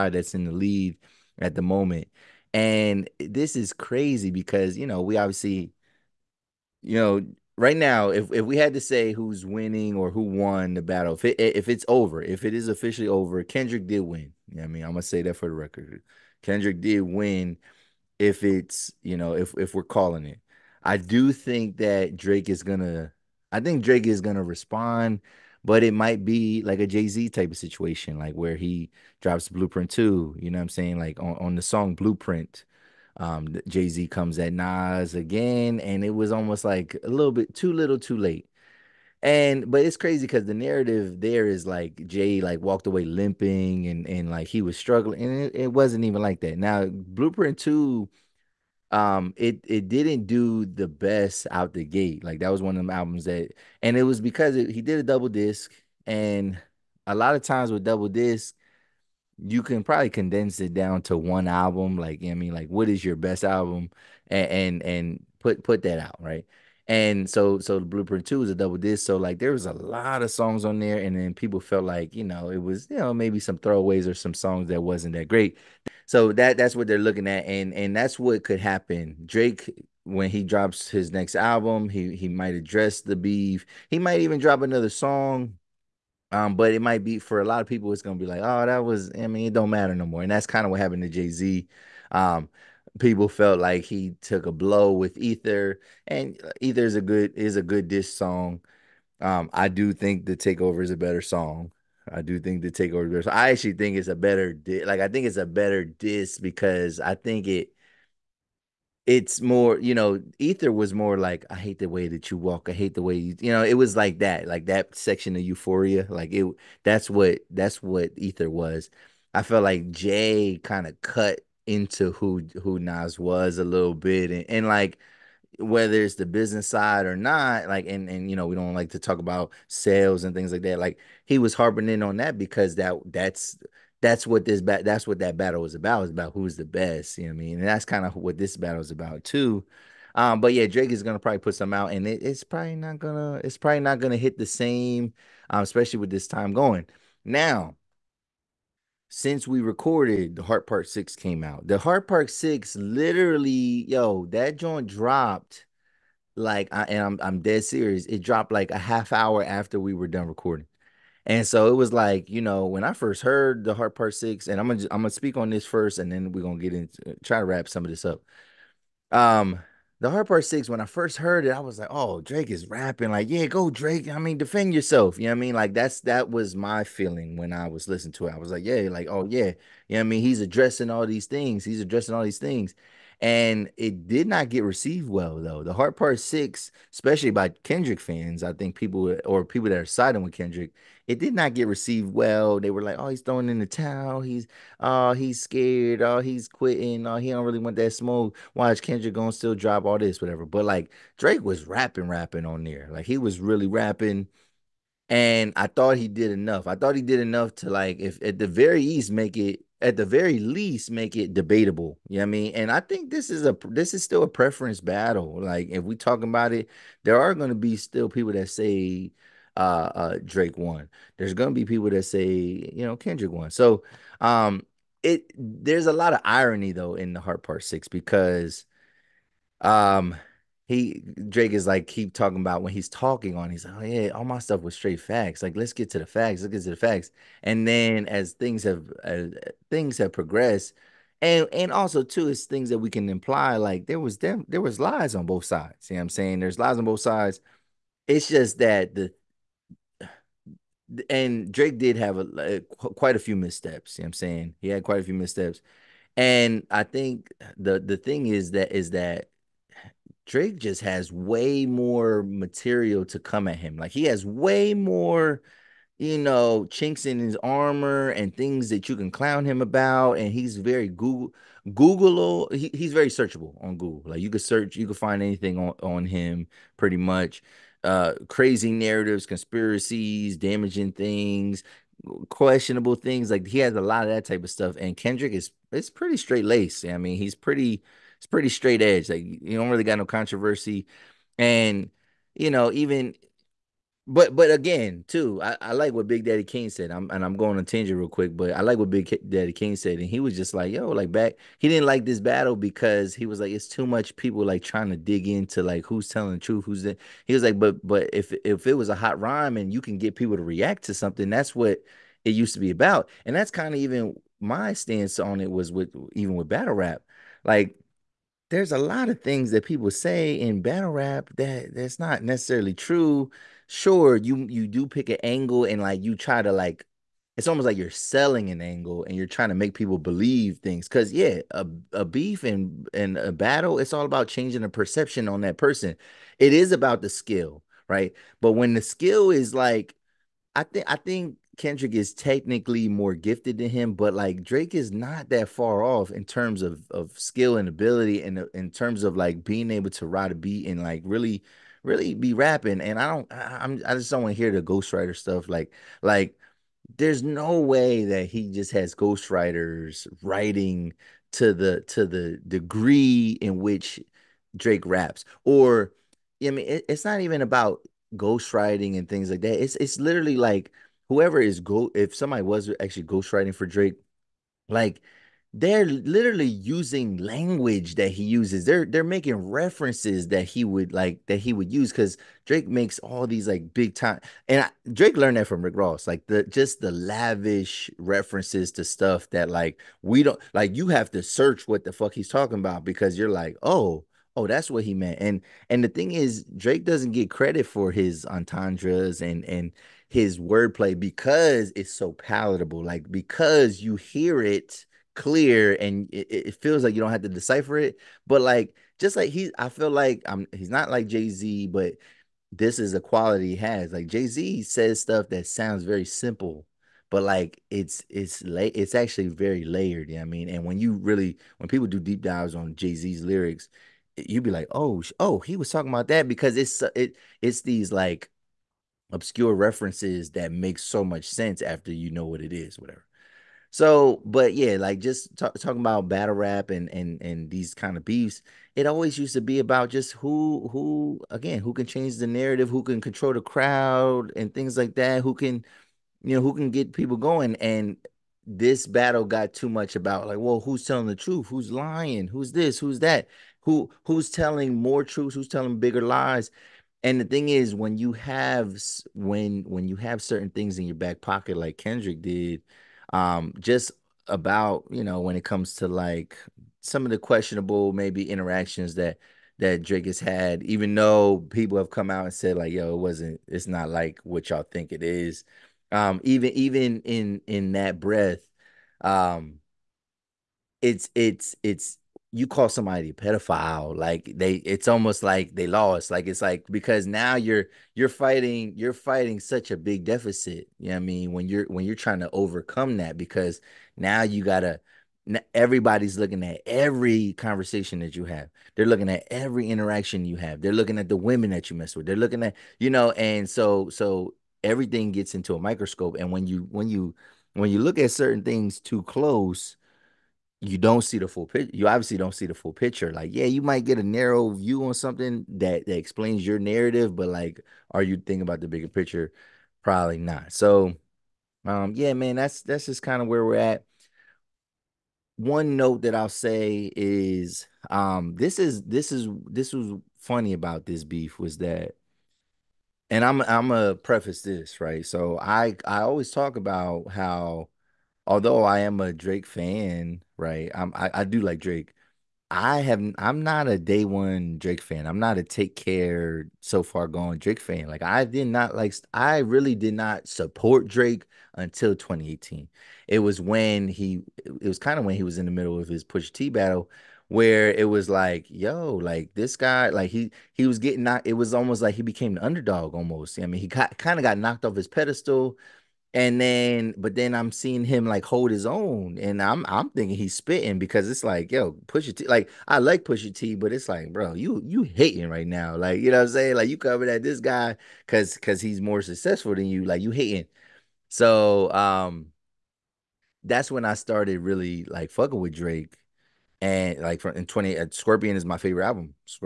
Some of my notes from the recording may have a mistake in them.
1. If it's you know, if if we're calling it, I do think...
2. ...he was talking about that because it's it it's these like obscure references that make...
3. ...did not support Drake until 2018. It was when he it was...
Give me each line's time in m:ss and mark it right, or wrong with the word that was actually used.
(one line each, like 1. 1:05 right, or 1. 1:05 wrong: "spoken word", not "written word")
1. 0:18 right
2. 7:05 right
3. 9:09 right.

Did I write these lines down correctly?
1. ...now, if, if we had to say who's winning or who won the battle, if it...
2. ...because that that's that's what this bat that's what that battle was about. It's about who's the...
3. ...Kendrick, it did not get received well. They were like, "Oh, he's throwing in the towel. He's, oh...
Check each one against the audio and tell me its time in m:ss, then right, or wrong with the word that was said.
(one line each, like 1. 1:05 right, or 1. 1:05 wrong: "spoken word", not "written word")
1. 0:07 right
2. 2:12 right
3. 3:10 right.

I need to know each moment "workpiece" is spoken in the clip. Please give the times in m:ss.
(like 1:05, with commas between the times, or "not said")
not said.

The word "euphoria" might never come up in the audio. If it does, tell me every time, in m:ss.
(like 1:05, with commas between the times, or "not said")
1:55.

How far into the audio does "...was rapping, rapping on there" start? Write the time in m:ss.
3:21.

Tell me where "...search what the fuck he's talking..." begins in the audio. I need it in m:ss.
6:31.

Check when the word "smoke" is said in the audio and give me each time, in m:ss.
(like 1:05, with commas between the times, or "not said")
3:17.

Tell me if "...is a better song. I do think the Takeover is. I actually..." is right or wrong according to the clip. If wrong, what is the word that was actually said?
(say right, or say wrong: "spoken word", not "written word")
right.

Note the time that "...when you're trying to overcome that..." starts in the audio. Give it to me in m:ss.
8:11.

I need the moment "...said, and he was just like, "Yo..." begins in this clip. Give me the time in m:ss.
4:59.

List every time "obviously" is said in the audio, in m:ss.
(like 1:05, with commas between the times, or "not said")
0:05, 8:31.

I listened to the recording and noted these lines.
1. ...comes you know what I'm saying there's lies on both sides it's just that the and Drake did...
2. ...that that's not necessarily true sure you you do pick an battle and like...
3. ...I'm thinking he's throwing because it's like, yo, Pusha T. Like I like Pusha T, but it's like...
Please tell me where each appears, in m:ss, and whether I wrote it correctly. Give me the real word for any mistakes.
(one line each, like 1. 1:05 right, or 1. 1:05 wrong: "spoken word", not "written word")
1. 4:05 wrong: "sides", not "comes"
2. 5:21 wrong: "angle", not "battle"
3. 9:29 wrong: "spitting", not "throwing".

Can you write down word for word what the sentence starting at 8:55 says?
So I I always talk about how although I am a Drake fan, right?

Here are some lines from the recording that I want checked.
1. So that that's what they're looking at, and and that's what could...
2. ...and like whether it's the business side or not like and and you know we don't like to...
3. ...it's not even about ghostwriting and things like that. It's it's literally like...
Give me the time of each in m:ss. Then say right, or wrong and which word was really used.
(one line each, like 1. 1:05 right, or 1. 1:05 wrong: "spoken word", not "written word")
1. 1:16 right
2. 2:04 right
3. 6:06 right.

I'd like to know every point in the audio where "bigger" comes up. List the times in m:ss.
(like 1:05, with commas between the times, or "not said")
7:35, 8:38.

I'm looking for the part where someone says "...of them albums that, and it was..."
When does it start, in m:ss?
0:52.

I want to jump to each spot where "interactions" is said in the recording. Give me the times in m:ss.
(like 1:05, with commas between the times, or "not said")
7:48, 8:19.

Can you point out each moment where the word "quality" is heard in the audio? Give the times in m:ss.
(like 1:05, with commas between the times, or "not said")
6:53.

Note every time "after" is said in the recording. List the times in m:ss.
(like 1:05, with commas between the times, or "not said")
2:39, 7:11.